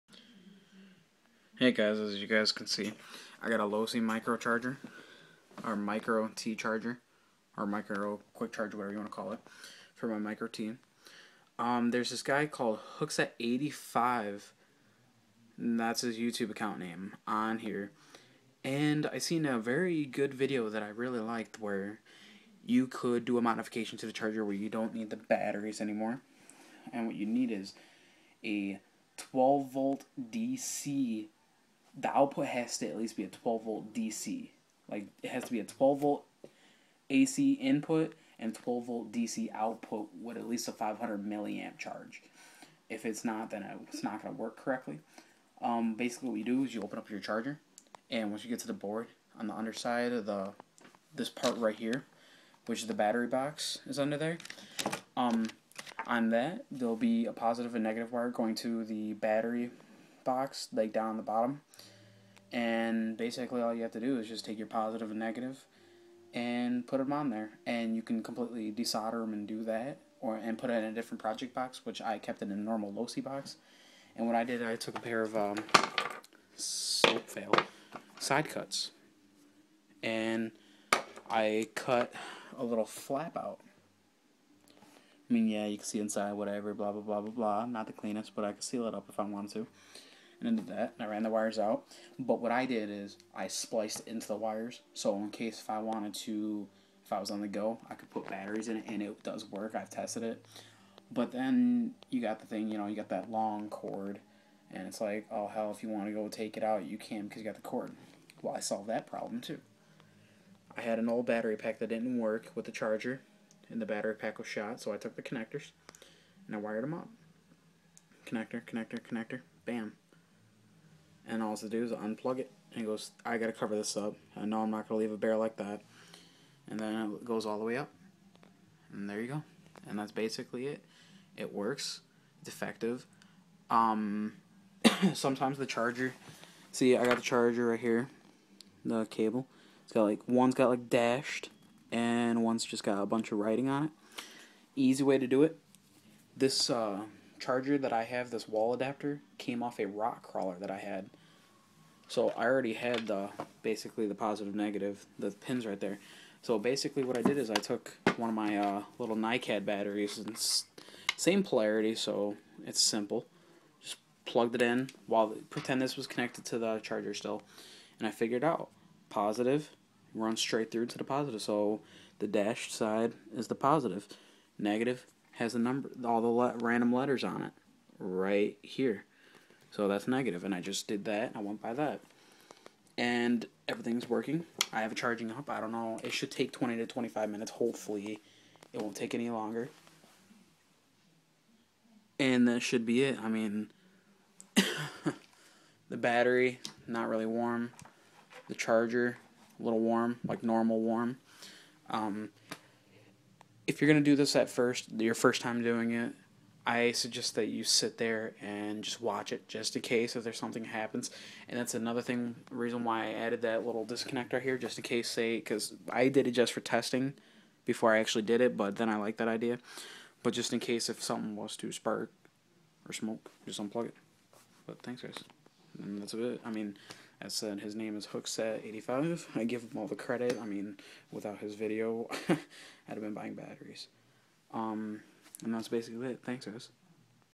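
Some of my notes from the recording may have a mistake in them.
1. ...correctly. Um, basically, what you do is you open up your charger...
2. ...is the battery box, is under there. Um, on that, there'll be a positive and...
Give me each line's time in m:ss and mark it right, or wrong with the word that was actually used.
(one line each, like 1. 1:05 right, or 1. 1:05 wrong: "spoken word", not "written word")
1. 0:44 right
2. 0:52 right.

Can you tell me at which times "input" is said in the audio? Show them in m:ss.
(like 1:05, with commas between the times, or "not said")
0:37.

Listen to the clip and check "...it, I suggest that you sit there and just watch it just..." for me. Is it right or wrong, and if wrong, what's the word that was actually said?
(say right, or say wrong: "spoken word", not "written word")
right.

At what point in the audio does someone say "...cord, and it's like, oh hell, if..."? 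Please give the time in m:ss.
1:43.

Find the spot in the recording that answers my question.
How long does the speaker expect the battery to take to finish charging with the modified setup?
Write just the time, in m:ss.
3:06.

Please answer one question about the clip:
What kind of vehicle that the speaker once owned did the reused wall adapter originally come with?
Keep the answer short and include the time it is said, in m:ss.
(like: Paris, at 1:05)
rock crawler, at 2:29.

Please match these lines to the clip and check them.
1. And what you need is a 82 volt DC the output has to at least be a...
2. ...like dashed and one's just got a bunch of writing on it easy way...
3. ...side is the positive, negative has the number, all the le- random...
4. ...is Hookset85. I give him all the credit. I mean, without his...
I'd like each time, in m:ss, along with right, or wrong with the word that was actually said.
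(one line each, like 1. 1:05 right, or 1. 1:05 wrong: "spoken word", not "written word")
1. 0:26 wrong: "12", not "82"
2. 2:20 right
3. 2:52 right
4. 3:47 right.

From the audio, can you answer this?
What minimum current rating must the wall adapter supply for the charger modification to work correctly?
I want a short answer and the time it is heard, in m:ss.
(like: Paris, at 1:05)
500 milliamps, at 0:40.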